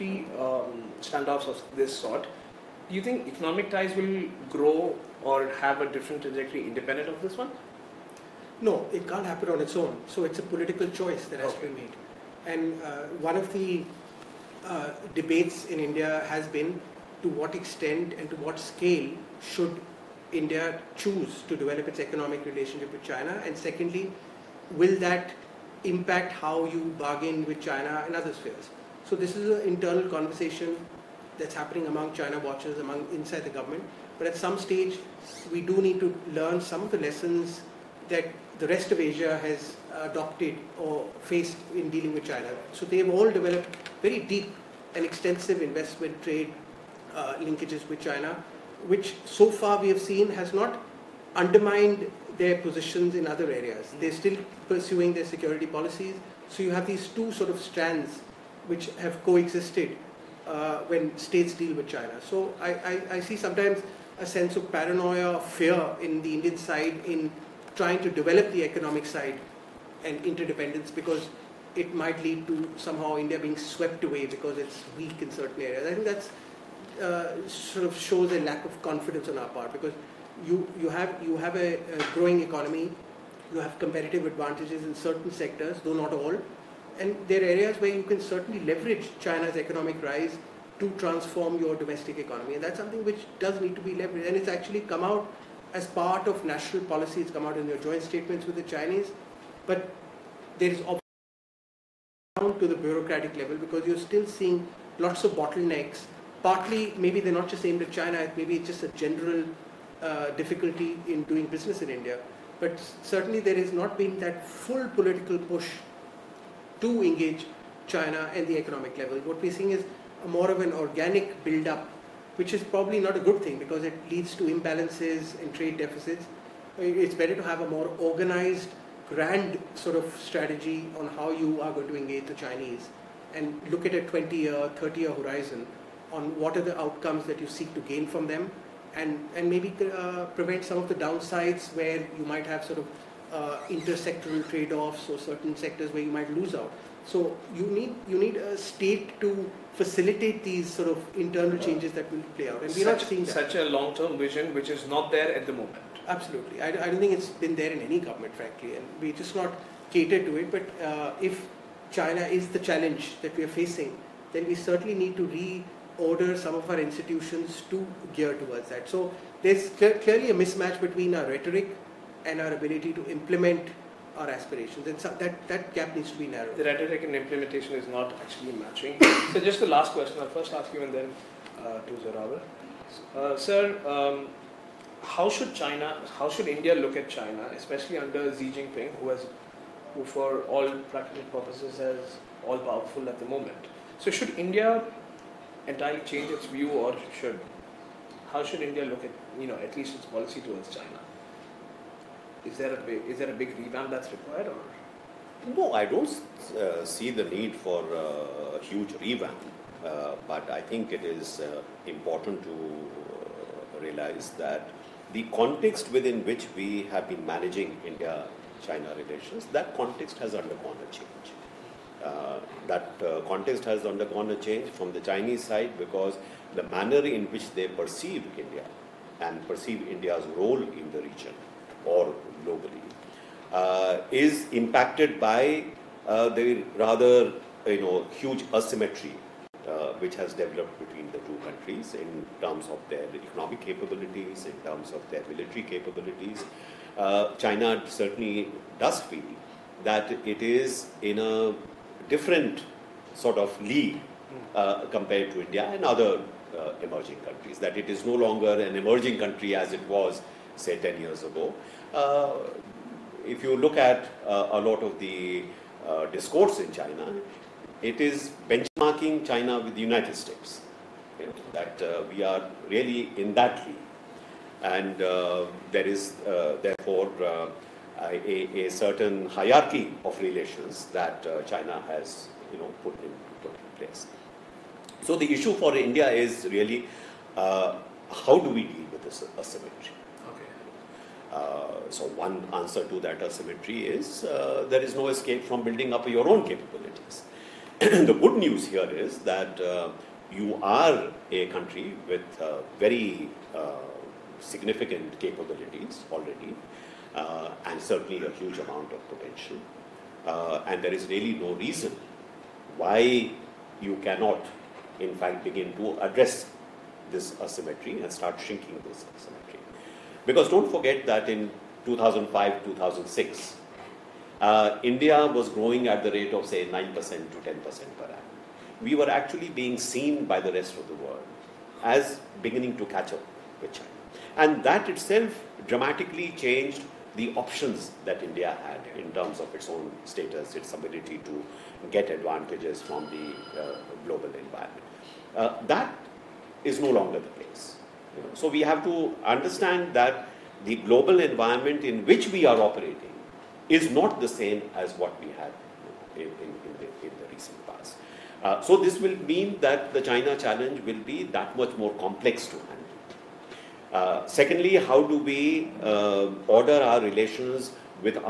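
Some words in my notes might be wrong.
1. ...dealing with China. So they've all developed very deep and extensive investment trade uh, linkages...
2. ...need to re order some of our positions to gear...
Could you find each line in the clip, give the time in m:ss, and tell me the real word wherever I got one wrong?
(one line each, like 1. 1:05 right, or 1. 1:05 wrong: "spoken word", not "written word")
1. 0:41 right
2. 2:44 wrong: "institutions", not "positions".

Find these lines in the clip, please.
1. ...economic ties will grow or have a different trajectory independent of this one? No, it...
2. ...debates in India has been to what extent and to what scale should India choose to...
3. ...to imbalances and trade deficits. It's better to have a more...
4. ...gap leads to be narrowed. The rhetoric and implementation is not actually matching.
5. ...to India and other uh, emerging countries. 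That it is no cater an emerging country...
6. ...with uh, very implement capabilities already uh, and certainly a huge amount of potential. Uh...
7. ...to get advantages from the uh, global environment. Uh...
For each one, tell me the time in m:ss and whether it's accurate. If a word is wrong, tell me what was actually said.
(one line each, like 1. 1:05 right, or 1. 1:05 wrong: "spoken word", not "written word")
1. 0:03 right
2. 0:15 right
3. 2:04 right
4. 2:55 wrong: "needs", not "leads"
5. 4:15 wrong: "longer", not "cater"
6. 5:02 wrong: "significant", not "implement"
7. 5:41 right.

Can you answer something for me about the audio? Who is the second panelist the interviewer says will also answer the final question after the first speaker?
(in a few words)
Zorawar.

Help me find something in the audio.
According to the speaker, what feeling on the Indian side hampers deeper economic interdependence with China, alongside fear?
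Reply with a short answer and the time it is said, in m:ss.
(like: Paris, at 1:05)
paranoia, at 1:04.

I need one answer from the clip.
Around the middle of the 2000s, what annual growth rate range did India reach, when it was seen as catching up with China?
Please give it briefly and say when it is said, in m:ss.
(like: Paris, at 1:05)
9% to 10%, at 5:26.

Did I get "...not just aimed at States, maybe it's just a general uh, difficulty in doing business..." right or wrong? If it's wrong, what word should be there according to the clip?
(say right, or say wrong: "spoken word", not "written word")
wrong: "China", not "States".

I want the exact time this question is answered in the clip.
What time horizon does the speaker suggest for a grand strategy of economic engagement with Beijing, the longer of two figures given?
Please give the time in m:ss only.
2:14.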